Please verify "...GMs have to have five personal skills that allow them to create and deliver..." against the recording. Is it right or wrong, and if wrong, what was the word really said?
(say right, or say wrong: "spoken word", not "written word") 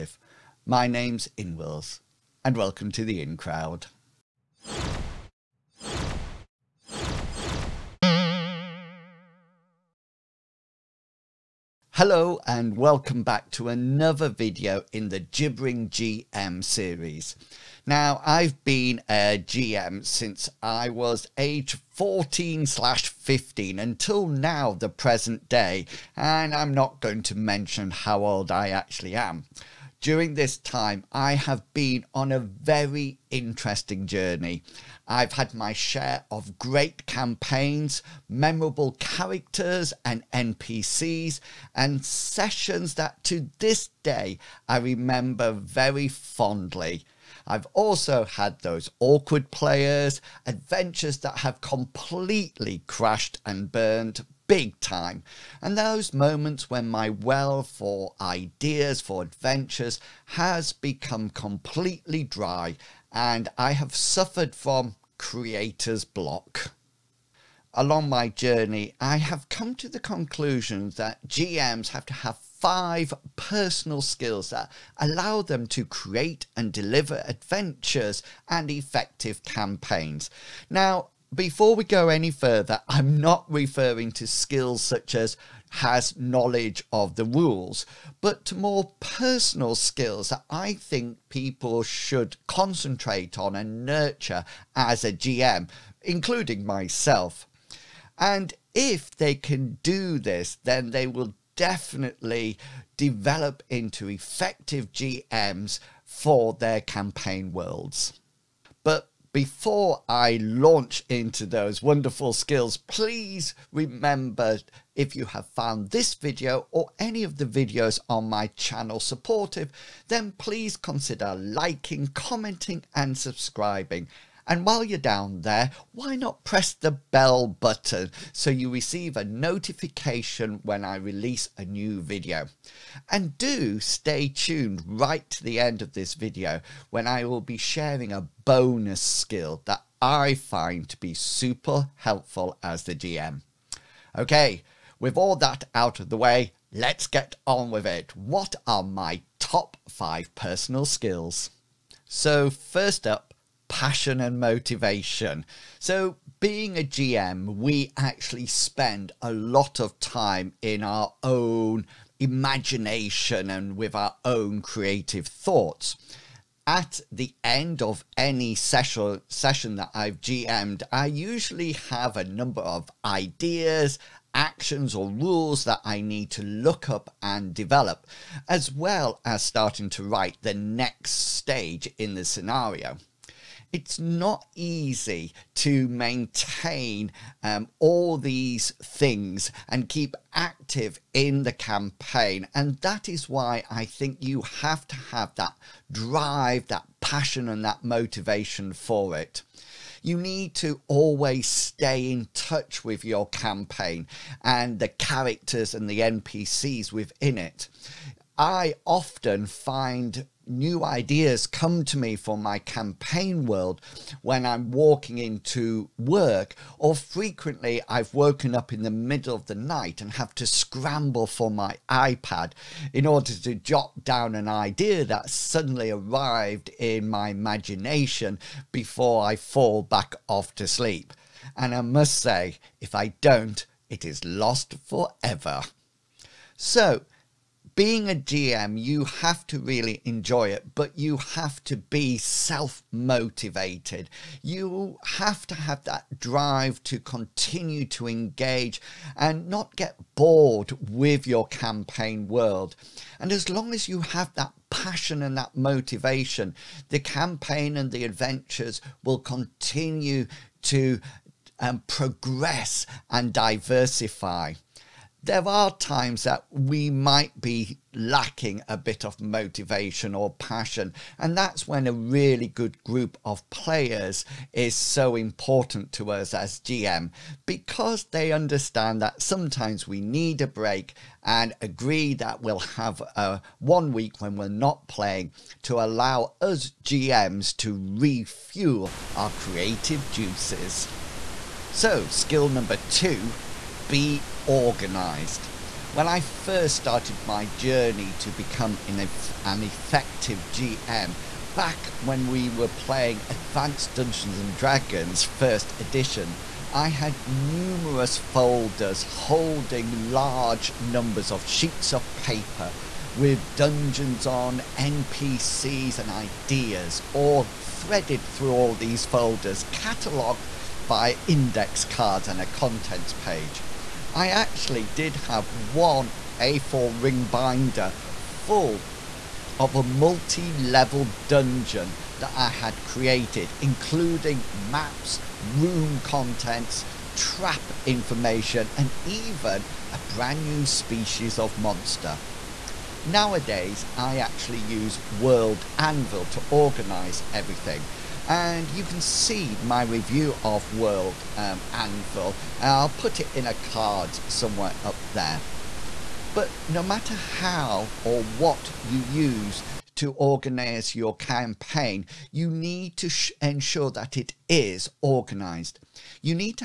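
right.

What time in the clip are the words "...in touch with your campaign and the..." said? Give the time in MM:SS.
03:22.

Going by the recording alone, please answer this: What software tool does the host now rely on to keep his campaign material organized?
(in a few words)
World Anvil.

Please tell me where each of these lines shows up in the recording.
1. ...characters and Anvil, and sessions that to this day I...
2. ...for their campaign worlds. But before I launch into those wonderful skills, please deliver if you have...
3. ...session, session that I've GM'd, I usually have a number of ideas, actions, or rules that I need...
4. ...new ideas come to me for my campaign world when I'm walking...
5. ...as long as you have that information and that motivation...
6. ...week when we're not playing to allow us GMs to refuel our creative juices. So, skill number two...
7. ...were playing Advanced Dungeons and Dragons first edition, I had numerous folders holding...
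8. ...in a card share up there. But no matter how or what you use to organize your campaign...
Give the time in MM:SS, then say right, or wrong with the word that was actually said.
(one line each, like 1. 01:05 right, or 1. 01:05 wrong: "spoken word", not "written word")
1. 00:38 wrong: "NPCs", not "Anvil"
2. 01:46 wrong: "remember", not "deliver"
3. 02:48 right
4. 03:30 right
5. 04:13 wrong: "passion", not "information"
6. 04:43 right
7. 05:02 right
8. 05:53 wrong: "somewhere", not "share".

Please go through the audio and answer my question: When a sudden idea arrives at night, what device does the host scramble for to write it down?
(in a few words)
iPad.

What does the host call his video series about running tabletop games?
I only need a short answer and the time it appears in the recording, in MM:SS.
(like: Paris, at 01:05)
Gibbering GM, at 00:15.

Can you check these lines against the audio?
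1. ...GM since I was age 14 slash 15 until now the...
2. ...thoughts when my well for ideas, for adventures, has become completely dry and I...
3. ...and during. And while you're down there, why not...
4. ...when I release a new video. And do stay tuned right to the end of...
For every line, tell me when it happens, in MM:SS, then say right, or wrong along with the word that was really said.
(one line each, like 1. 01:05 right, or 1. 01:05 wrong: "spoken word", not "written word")
1. 00:19 right
2. 00:56 wrong: "moments", not "thoughts"
3. 02:02 wrong: "subscribing", not "during"
4. 02:10 right.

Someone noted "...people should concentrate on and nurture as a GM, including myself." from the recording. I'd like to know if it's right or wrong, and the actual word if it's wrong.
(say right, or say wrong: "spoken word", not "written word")
right.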